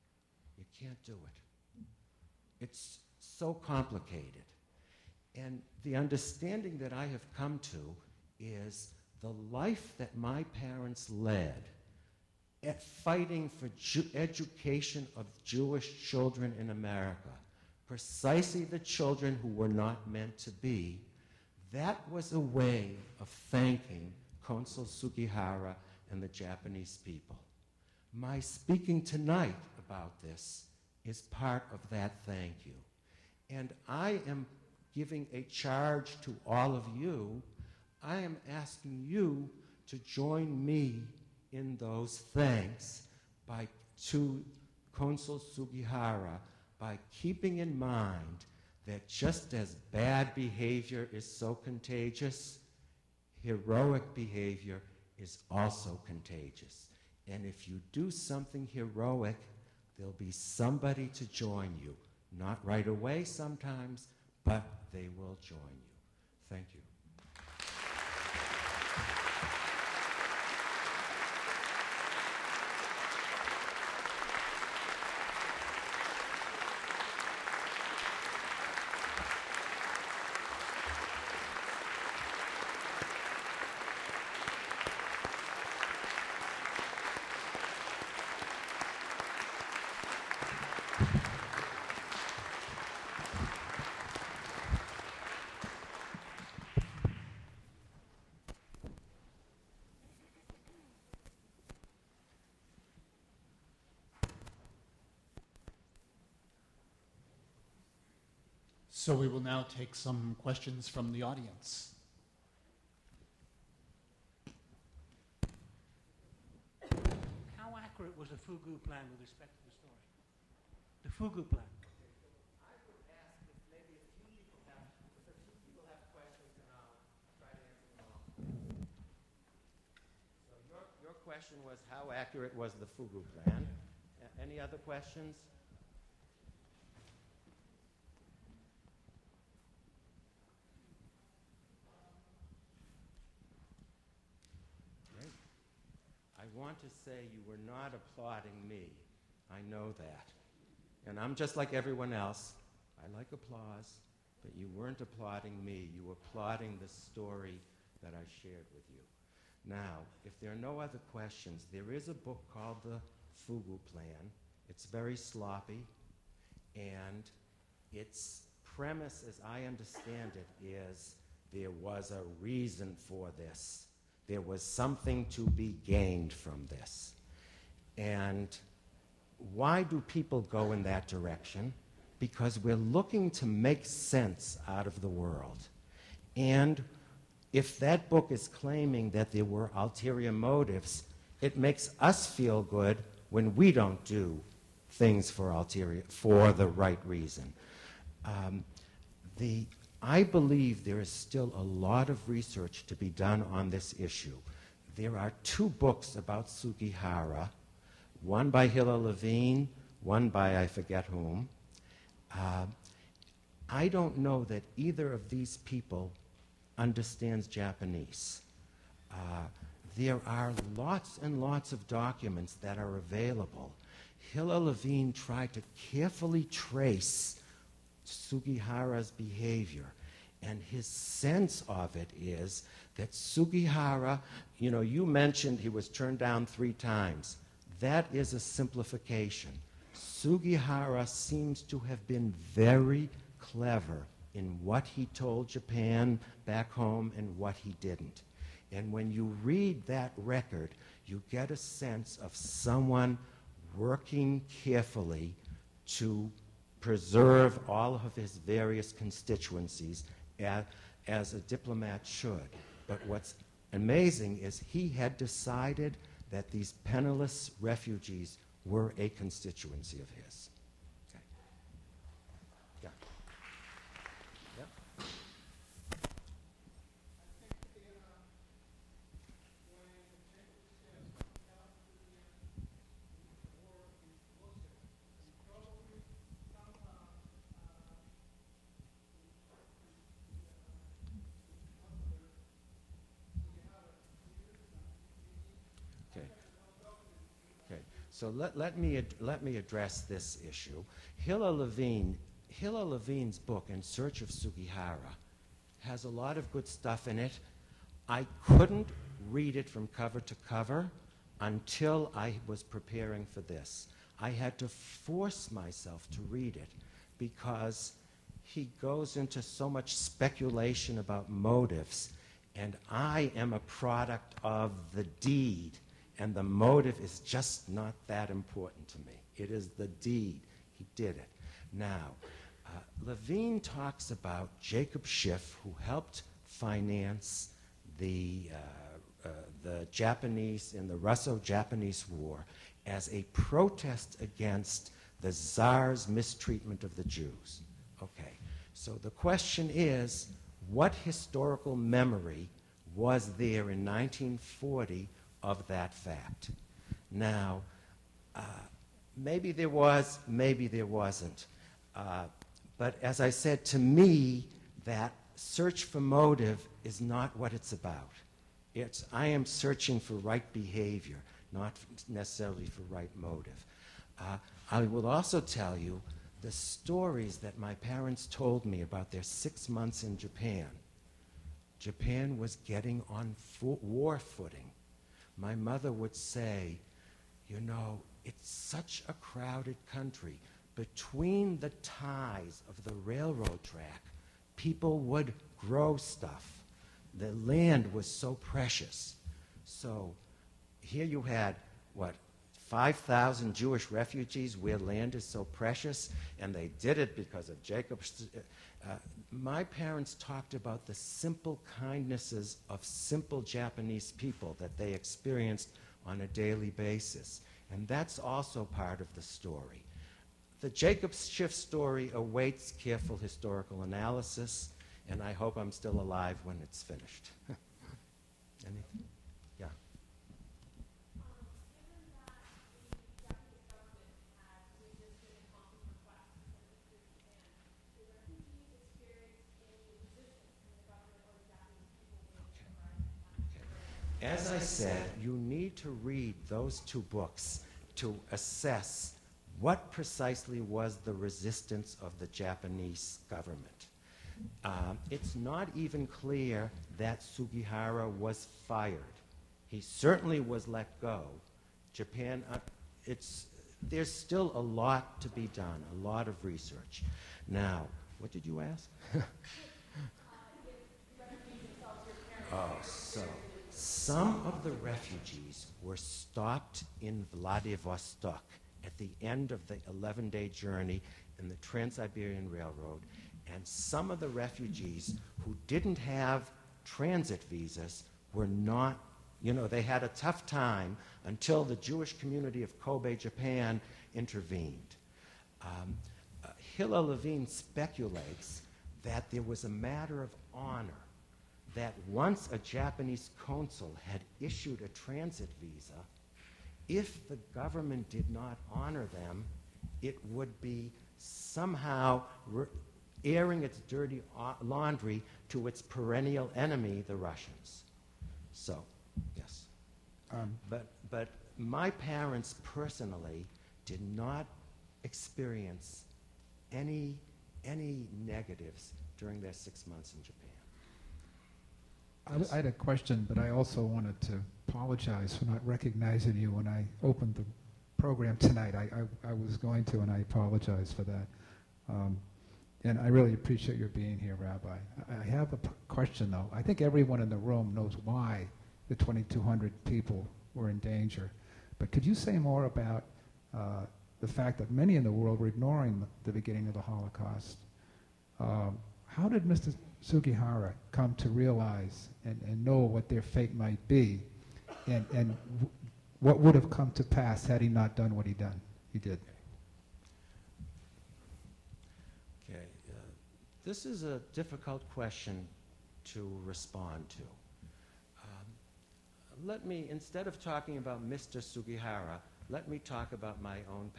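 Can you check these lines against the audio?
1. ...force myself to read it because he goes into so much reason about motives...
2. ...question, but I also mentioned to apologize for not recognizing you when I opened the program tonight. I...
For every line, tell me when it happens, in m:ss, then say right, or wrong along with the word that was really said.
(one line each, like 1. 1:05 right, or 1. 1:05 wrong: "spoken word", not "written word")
1. 5:14 wrong: "speculation", not "reason"
2. 8:52 wrong: "wanted", not "mentioned".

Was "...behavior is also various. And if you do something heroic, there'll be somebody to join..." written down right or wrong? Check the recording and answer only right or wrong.
wrong.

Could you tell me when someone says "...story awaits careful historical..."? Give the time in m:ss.
7:01.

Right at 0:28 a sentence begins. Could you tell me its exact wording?
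My speaking tonight about this is part of that thank you.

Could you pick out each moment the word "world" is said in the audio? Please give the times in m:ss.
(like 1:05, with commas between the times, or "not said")
3:05, 9:15.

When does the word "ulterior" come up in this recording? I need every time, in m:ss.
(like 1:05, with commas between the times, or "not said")
3:09, 3:15.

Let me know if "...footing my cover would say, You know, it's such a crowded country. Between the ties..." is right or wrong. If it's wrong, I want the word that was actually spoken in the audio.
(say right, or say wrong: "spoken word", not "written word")
wrong: "mother", not "cover".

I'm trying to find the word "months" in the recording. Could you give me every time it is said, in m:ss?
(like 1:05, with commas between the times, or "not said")
6:19, 8:49.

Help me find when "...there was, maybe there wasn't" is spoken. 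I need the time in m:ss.
5:59.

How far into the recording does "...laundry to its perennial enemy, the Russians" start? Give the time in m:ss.
8:34.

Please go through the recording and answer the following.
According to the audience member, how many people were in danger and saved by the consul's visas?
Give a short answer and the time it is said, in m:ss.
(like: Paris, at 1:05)
2,200, at 9:08.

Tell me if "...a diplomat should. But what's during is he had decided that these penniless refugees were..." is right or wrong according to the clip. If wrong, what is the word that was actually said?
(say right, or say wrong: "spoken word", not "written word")
wrong: "amazing", not "during".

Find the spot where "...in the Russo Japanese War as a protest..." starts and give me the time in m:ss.
5:40.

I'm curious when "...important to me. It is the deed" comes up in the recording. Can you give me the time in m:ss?
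5:28.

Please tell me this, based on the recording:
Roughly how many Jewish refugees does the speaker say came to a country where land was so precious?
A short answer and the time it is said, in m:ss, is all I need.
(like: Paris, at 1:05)
5,000, at 6:42.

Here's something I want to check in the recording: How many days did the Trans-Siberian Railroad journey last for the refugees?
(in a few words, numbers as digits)
11.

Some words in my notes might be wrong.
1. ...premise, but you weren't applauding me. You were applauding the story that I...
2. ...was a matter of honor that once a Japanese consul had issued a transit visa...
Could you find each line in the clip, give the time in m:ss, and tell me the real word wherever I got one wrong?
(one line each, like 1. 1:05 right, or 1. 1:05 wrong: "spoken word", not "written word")
1. 2:33 wrong: "applause", not "premise"
2. 8:19 right.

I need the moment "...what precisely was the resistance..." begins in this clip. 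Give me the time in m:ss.
7:29.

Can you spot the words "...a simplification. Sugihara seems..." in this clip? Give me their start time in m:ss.
3:58.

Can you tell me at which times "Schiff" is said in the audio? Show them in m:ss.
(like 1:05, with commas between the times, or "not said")
5:35, 7:01.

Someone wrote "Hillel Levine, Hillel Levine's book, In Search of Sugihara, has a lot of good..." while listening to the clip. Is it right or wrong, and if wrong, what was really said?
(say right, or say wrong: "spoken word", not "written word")
right.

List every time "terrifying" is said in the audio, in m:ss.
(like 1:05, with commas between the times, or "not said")
not said.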